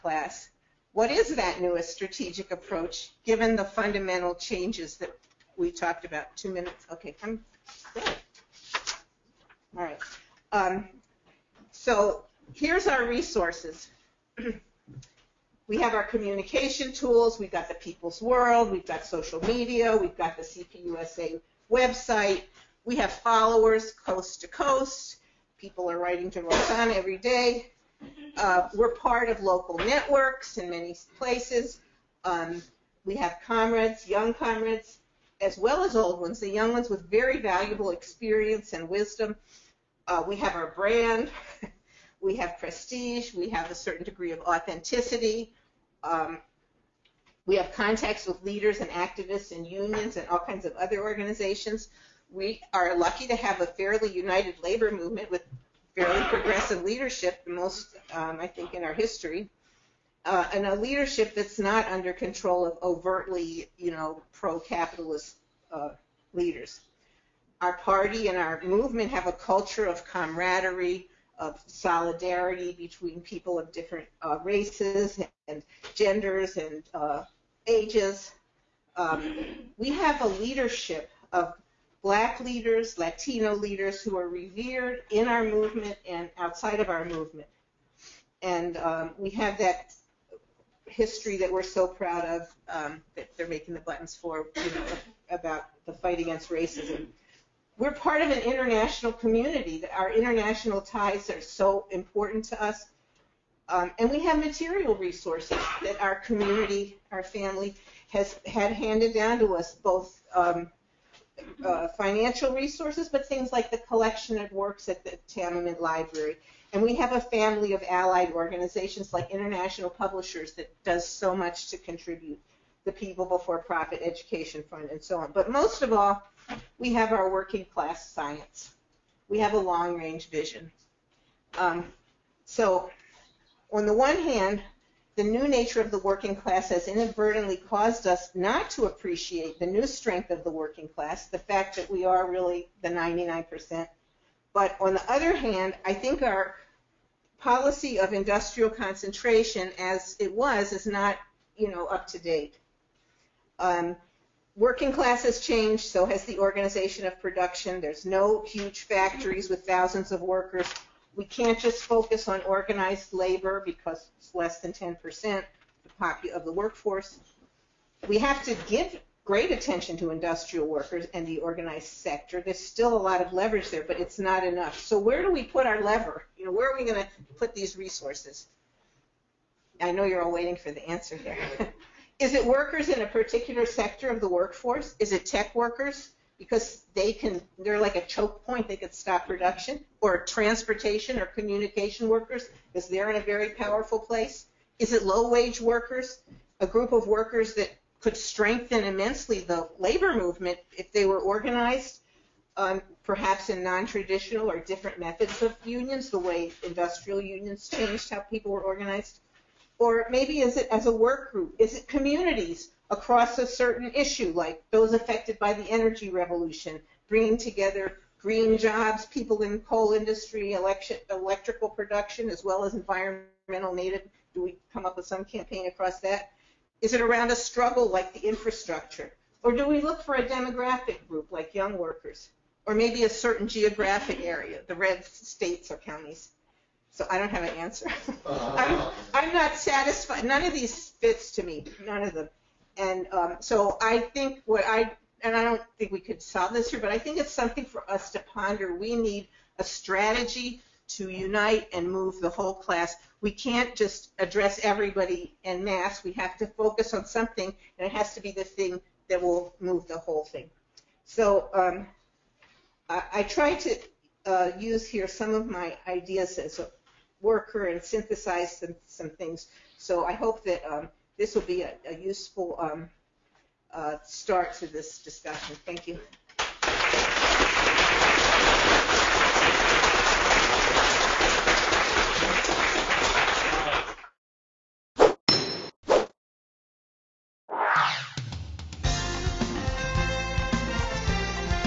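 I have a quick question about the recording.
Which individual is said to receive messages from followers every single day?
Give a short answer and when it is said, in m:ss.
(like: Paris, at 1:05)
Roxanne, at 0:26.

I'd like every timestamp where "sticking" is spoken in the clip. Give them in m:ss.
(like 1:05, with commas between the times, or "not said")
not said.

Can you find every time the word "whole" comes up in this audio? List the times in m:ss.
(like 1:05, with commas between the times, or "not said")
4:12, 4:19.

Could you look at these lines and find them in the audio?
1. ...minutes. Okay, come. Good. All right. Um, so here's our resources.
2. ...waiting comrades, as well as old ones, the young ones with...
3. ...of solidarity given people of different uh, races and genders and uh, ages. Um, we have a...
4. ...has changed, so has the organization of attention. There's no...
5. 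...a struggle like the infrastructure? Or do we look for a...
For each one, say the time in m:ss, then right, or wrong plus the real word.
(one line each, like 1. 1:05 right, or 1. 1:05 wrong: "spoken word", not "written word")
1. 0:06 right
2. 0:34 wrong: "young", not "waiting"
3. 1:11 wrong: "between", not "given"
4. 2:35 wrong: "production", not "attention"
5. 3:47 right.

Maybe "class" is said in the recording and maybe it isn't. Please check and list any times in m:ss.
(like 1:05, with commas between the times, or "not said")
2:07, 2:16, 2:20, 2:34, 4:12.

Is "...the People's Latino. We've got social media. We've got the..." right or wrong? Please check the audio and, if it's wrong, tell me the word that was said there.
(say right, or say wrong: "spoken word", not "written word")
wrong: "World", not "Latino".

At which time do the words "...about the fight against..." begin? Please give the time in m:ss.
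1:35.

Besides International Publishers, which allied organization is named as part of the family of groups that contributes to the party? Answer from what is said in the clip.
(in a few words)
People Before Profit Education Fund.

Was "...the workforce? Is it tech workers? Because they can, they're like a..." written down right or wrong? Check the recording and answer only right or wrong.
right.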